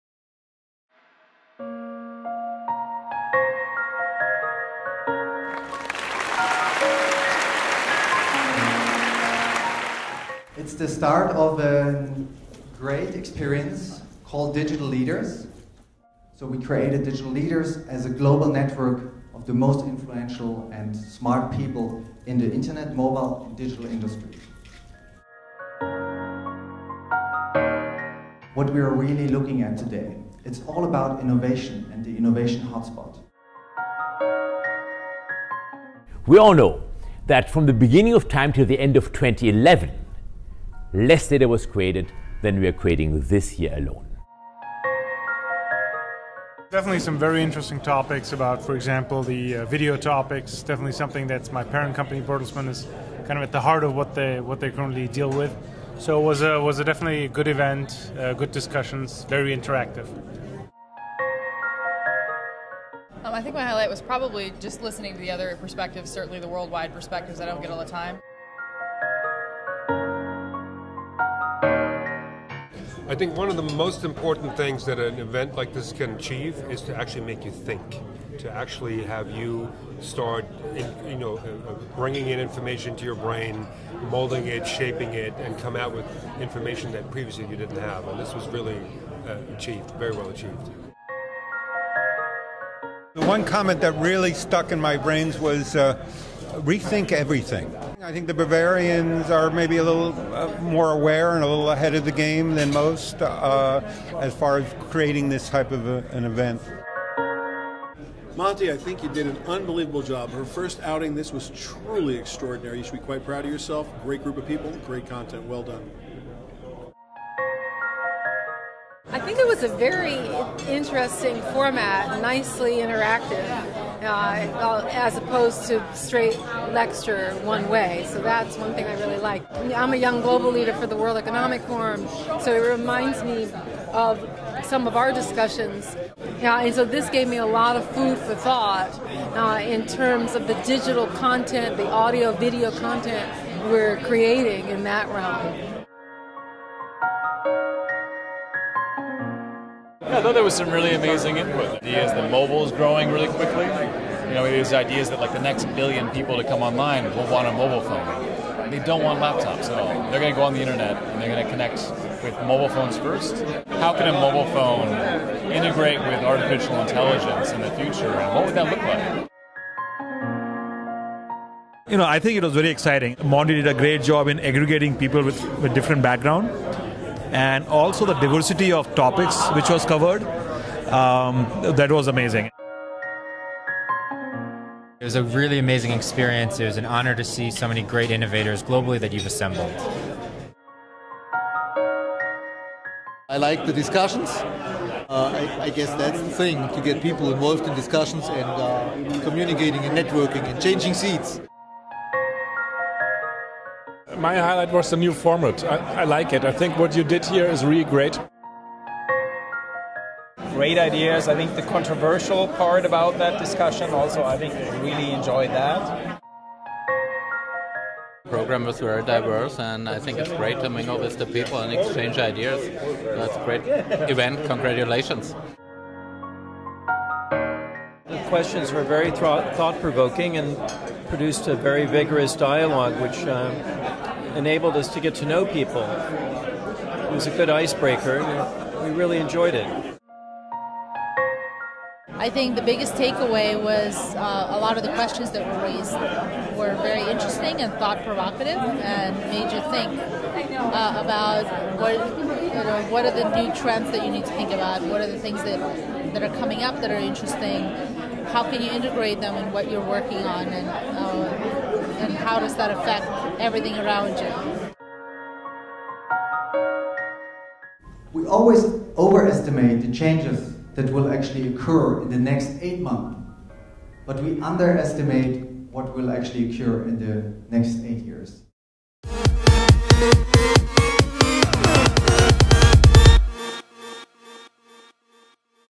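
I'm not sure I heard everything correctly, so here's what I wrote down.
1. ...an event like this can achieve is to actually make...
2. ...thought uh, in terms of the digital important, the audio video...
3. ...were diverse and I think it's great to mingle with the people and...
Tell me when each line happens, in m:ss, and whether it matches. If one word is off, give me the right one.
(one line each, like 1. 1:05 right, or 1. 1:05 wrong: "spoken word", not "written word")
1. 1:14 right
2. 2:18 wrong: "content", not "important"
3. 3:38 right.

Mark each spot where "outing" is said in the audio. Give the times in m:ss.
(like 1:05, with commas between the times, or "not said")
1:50.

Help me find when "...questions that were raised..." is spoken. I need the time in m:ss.
4:04.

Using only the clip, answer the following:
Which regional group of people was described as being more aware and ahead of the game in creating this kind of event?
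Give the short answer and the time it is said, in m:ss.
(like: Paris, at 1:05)
The Bavarians, at 1:38.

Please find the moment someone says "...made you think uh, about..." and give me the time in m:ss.
4:09.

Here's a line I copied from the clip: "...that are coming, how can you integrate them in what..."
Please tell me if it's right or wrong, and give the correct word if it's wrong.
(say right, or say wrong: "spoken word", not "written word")
wrong: "interesting", not "coming".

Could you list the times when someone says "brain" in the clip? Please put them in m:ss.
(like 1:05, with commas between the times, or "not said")
1:23, 1:34.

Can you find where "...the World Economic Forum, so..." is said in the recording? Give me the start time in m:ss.
2:10.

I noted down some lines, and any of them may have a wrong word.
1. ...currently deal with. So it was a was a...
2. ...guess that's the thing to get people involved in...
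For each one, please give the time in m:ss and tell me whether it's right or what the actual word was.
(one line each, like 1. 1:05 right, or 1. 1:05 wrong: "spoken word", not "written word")
1. 0:54 right
2. 3:15 right.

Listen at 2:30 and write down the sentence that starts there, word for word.
Yeah, I thought there was some really amazing input.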